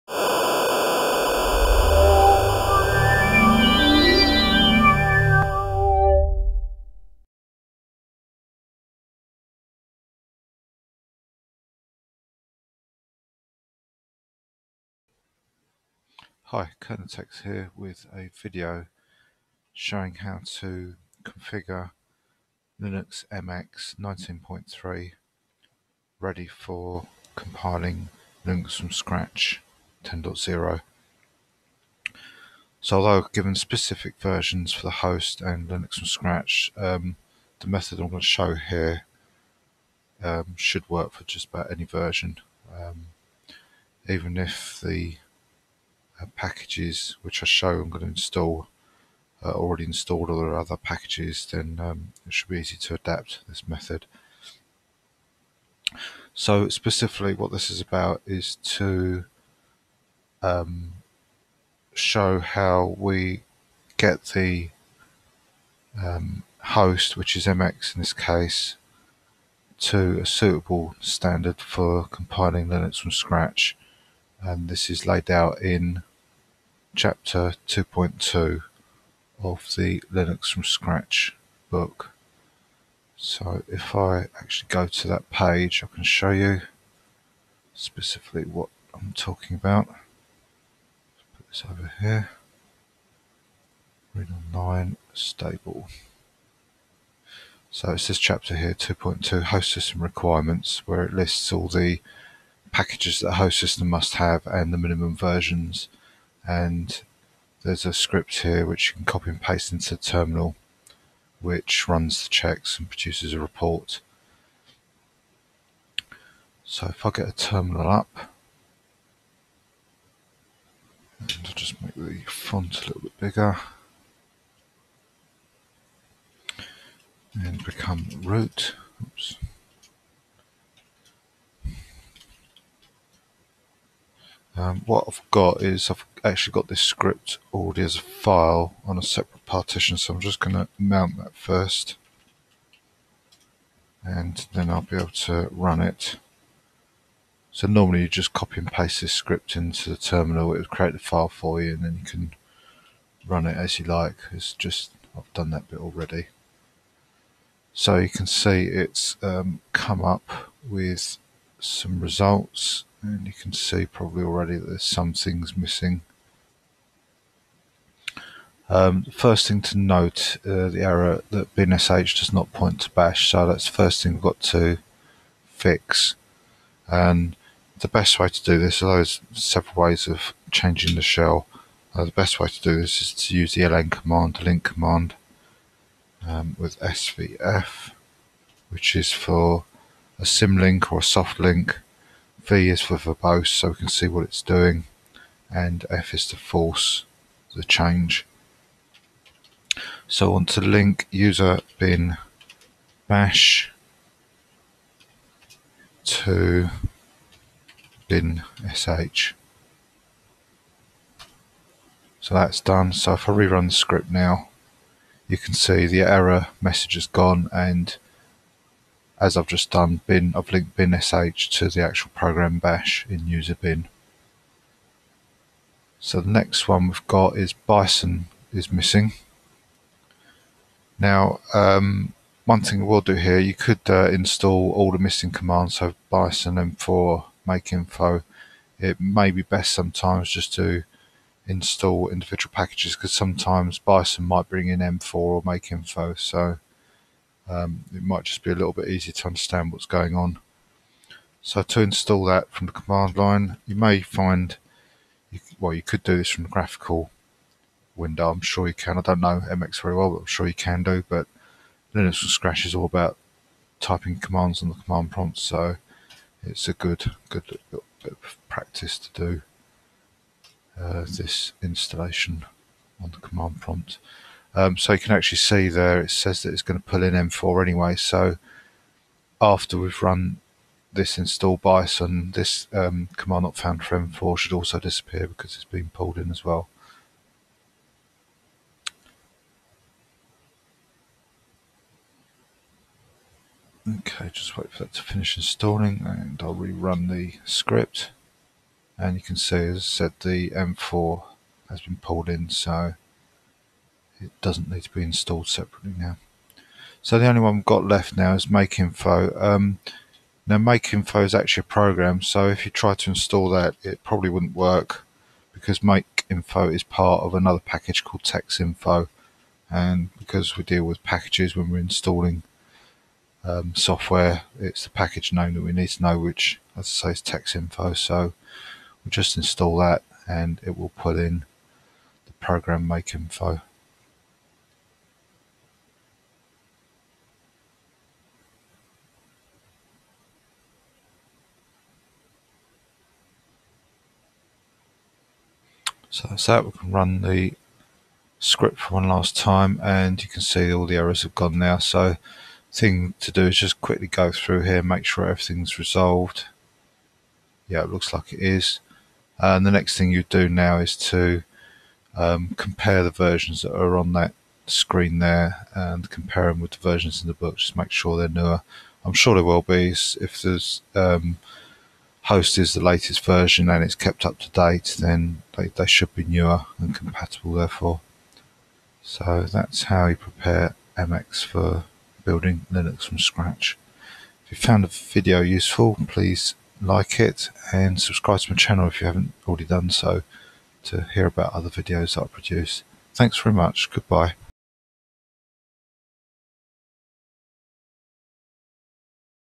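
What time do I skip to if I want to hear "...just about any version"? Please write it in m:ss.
0:41.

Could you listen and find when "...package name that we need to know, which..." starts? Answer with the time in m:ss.
5:24.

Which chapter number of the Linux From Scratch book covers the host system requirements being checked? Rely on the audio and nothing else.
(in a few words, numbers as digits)
2.2.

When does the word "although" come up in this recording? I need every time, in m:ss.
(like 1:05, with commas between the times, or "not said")
0:32, 2:58.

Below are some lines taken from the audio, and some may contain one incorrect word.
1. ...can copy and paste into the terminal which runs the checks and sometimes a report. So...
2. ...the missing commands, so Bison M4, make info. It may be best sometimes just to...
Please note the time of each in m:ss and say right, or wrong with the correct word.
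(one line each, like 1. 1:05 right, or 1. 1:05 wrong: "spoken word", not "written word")
1. 1:48 wrong: "produces", not "sometimes"
2. 3:54 right.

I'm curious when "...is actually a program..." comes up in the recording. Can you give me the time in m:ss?
5:11.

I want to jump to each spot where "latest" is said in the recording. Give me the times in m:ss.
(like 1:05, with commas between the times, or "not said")
6:12.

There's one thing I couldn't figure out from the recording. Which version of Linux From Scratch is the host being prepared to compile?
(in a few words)
10.0.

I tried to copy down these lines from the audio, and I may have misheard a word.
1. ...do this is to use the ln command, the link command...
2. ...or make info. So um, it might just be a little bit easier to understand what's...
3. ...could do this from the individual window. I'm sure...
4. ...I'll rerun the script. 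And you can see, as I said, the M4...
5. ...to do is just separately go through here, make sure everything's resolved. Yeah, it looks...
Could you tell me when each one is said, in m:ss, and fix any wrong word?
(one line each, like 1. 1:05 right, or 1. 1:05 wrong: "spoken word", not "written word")
1. 3:02 right
2. 4:05 right
3. 4:15 wrong: "graphical", not "individual"
4. 4:56 right
5. 5:53 wrong: "quickly", not "separately".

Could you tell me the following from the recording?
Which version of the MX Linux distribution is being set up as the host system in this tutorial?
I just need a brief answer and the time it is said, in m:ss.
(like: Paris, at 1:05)
19.3, at 0:23.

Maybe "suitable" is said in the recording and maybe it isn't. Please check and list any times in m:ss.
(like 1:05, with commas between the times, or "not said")
1:10.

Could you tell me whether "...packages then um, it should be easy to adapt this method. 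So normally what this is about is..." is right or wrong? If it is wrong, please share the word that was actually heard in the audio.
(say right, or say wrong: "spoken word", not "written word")
wrong: "specifically", not "normally".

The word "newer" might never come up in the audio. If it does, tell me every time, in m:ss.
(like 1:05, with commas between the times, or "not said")
6:08, 6:16.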